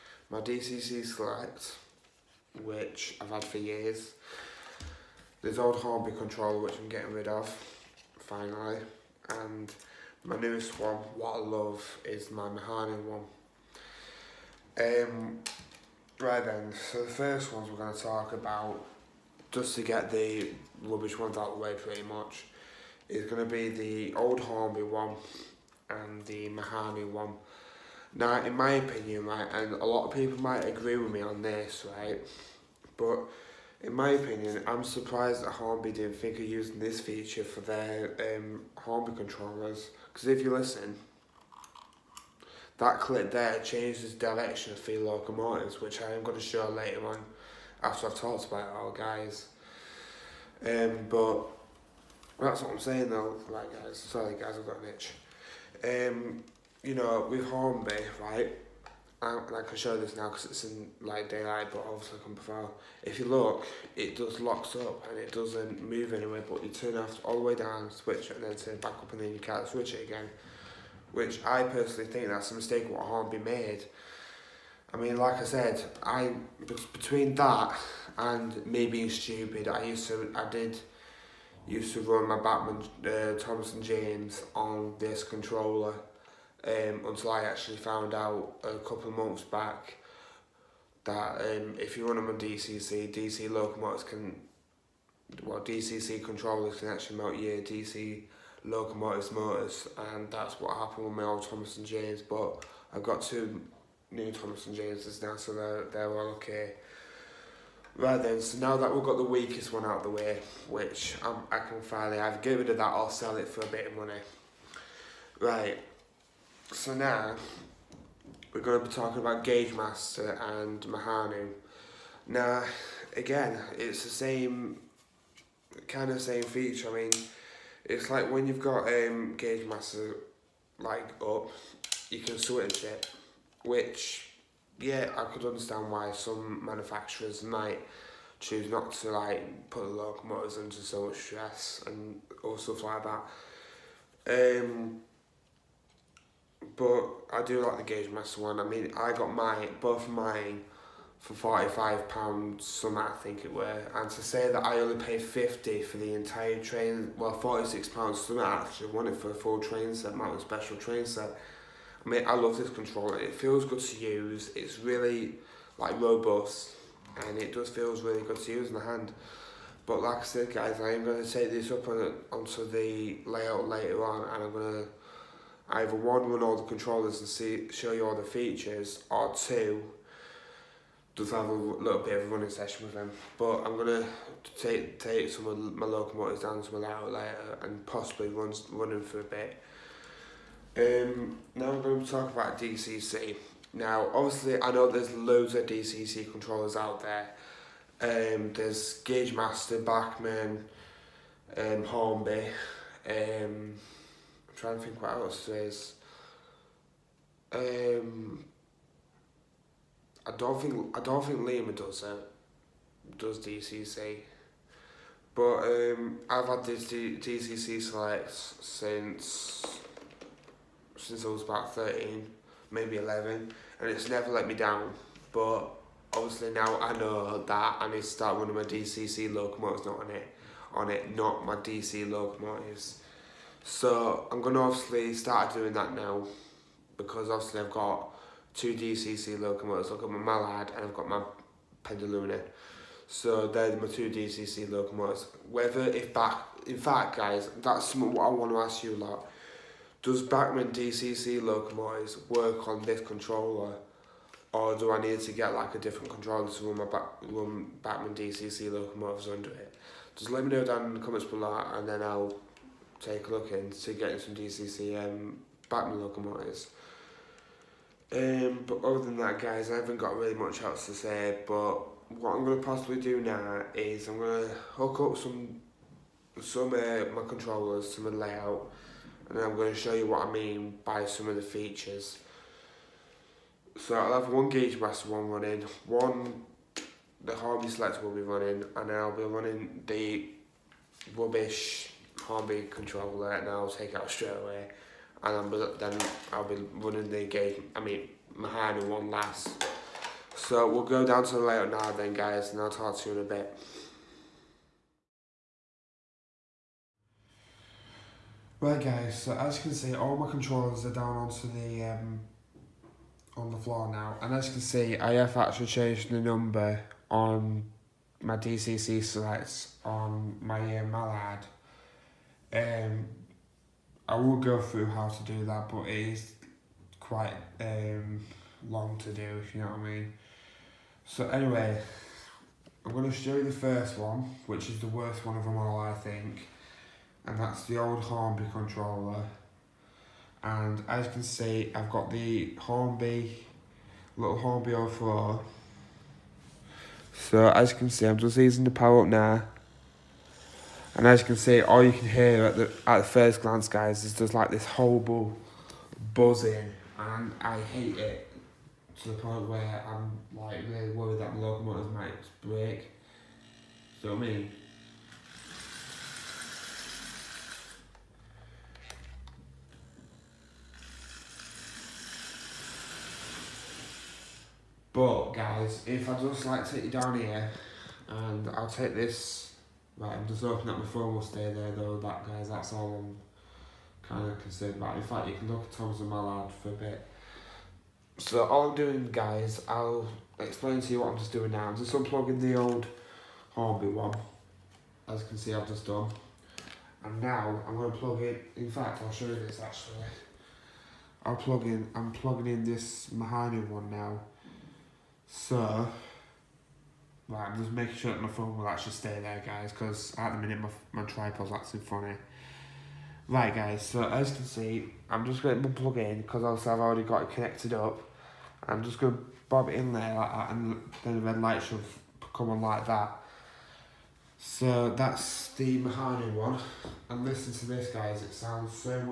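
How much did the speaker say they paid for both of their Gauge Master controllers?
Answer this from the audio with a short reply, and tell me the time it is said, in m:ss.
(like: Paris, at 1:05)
£45, at 2:31.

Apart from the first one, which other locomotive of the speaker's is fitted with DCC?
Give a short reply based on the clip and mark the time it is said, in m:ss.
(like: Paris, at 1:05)
Pendolino, at 4:01.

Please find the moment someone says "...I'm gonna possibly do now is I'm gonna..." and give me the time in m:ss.
4:32.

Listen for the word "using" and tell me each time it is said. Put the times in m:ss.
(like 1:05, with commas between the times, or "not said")
0:36, 5:48.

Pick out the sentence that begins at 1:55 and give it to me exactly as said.
Right, so now we're going to be talking about Gauge Master and Mehano.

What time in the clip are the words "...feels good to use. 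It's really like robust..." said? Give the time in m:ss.
2:43.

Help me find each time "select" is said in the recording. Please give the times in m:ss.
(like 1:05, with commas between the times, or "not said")
0:01, 3:37, 4:47, 5:19.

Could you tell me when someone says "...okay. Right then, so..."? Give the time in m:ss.
1:46.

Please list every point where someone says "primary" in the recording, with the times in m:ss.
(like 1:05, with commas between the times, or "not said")
not said.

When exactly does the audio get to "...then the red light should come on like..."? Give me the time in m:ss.
7:01.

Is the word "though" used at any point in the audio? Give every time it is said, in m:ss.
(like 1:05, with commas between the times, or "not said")
0:53, 6:21.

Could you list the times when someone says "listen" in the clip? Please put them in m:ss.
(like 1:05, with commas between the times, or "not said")
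0:40, 7:07.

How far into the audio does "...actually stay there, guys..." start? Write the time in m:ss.
6:48.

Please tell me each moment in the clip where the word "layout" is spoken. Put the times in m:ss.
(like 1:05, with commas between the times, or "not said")
2:53, 4:38, 5:01.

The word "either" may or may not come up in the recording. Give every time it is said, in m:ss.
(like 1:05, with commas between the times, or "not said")
1:52, 2:55.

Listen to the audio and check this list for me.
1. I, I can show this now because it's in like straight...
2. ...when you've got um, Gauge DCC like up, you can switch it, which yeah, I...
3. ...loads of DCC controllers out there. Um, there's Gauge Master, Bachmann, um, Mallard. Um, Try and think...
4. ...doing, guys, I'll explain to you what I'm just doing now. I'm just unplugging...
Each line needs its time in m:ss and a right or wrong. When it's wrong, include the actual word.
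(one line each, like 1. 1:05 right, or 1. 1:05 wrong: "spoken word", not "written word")
1. 0:59 wrong: "daylight", not "straight"
2. 2:08 wrong: "Master", not "DCC"
3. 3:15 wrong: "Hornby", not "Mallard"
4. 6:28 right.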